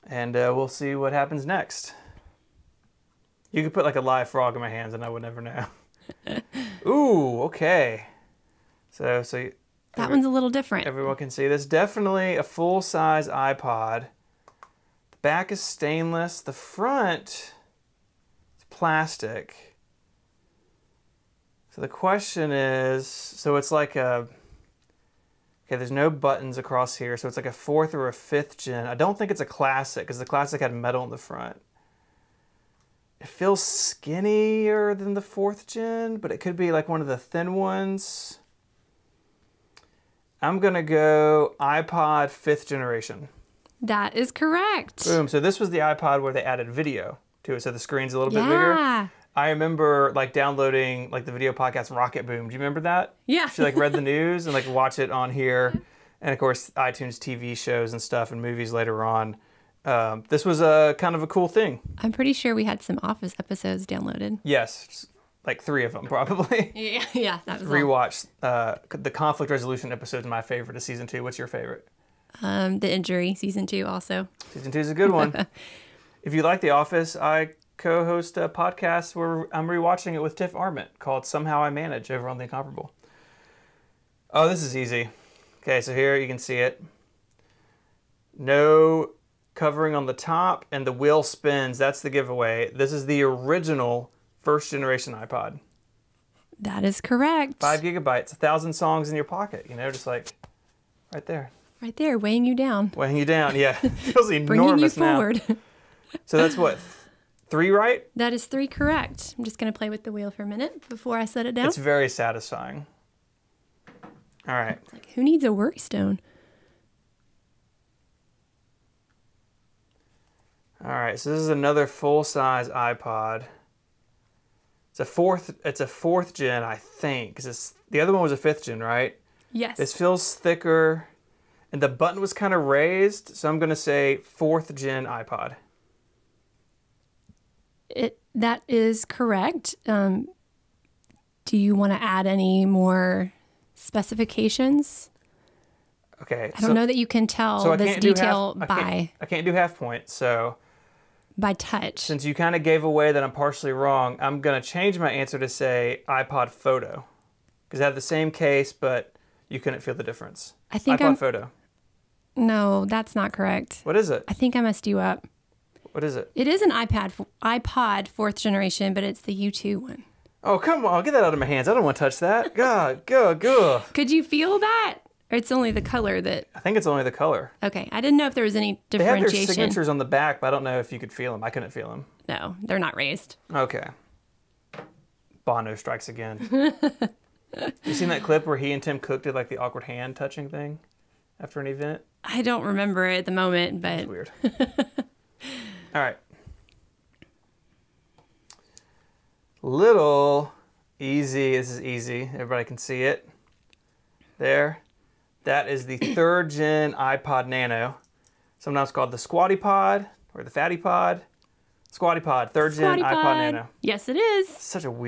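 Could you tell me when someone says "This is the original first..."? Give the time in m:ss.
1:32.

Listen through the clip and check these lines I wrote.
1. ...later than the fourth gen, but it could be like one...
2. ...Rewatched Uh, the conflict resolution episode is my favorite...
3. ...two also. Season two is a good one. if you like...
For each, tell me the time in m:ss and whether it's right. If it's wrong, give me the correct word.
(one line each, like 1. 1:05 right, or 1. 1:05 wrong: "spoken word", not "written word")
1. 0:33 wrong: "skinnier", not "later"
2. 1:07 right
3. 1:13 right.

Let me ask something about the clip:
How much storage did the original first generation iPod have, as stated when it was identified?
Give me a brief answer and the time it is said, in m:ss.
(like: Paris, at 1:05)
5 gigabytes, at 1:37.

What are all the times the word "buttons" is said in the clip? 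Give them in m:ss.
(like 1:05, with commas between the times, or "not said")
0:26, 2:11.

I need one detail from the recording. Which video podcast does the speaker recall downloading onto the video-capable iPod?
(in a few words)
Rocketboom.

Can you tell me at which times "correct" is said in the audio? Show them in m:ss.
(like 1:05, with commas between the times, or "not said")
0:44, 1:37, 1:48, 2:19, 2:43.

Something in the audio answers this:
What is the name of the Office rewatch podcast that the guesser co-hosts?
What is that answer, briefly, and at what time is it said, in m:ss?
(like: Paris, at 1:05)
Somehow I Manage, at 1:21.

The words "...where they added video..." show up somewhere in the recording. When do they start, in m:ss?
0:46.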